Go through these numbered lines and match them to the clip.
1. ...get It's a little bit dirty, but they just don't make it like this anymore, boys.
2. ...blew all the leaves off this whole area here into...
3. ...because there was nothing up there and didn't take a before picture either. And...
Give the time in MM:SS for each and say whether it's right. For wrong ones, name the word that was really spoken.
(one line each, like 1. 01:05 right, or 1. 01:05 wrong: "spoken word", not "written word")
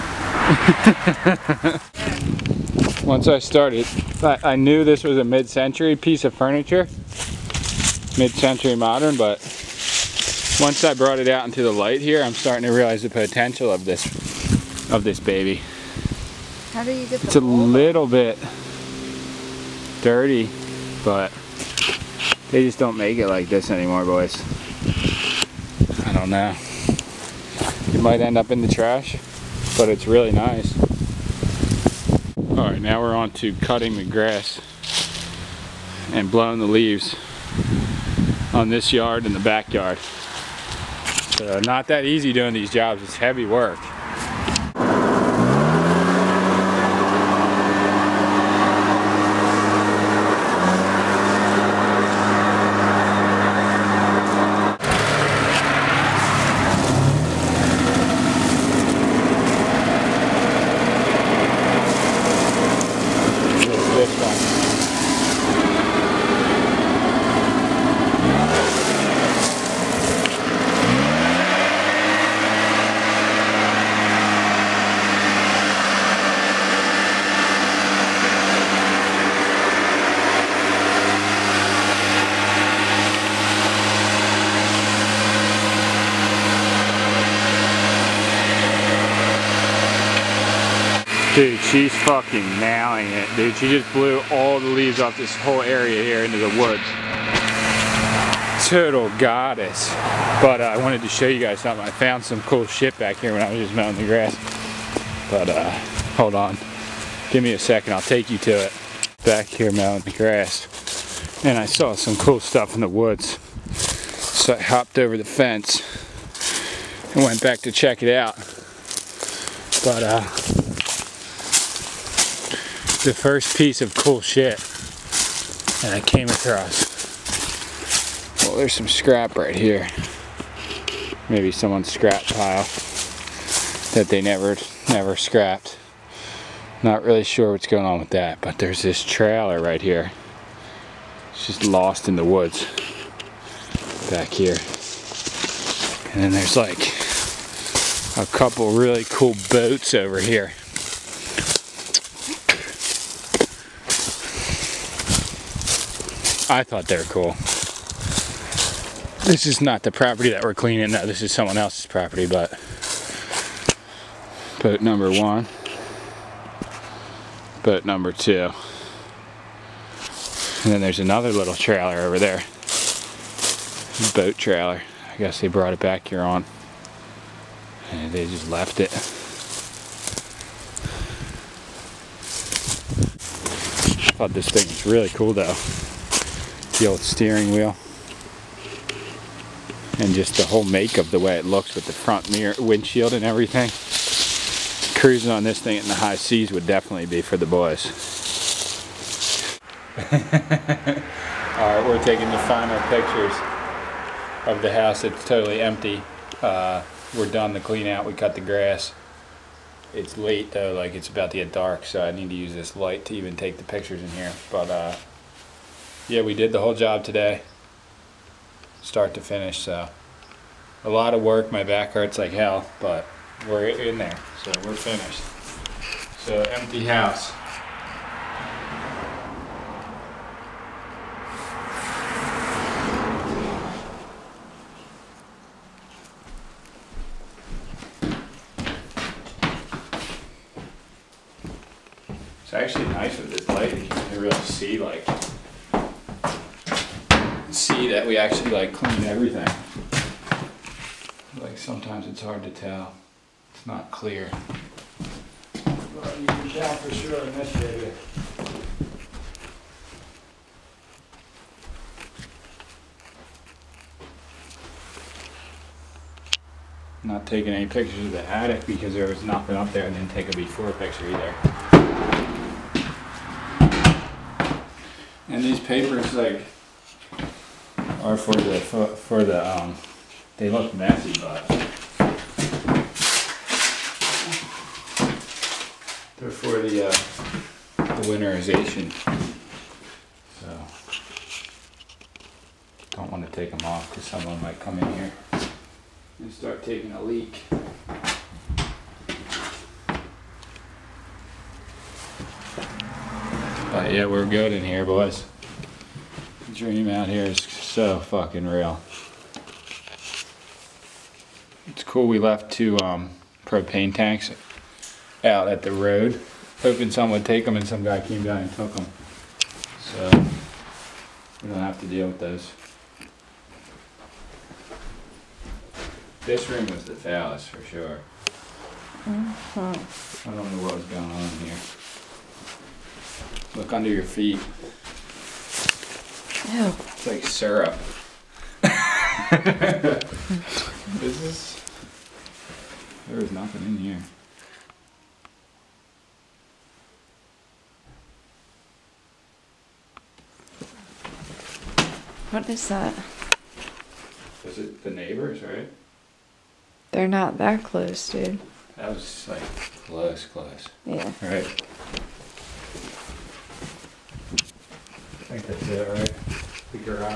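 1. 00:17 right
2. 01:33 right
3. 04:28 right.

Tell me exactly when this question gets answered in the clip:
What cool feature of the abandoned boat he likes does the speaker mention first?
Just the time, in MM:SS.
03:06.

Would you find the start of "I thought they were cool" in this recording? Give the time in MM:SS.
02:36.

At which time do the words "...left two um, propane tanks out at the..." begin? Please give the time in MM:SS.
05:12.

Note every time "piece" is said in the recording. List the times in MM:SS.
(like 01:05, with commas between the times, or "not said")
00:05, 02:03.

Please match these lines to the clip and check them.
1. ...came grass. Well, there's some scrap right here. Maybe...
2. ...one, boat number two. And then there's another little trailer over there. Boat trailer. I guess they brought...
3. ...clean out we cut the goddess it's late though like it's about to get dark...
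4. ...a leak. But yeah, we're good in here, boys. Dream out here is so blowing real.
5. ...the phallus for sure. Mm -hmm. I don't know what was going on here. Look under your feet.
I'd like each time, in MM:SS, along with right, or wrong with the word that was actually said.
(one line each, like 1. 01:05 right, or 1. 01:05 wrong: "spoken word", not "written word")
1. 02:06 wrong: "across", not "grass"
2. 02:45 right
3. 03:27 wrong: "grass", not "goddess"
4. 04:56 wrong: "fucking", not "blowing"
5. 05:26 right.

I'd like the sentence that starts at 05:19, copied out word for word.
So we don't have to deal with those.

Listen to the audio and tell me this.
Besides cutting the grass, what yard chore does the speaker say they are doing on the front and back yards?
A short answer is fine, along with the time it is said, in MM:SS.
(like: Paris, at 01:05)
blowing the leaves, at 00:36.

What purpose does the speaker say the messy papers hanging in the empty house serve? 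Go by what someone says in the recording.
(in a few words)
winterization.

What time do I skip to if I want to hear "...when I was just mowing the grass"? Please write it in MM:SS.
01:43.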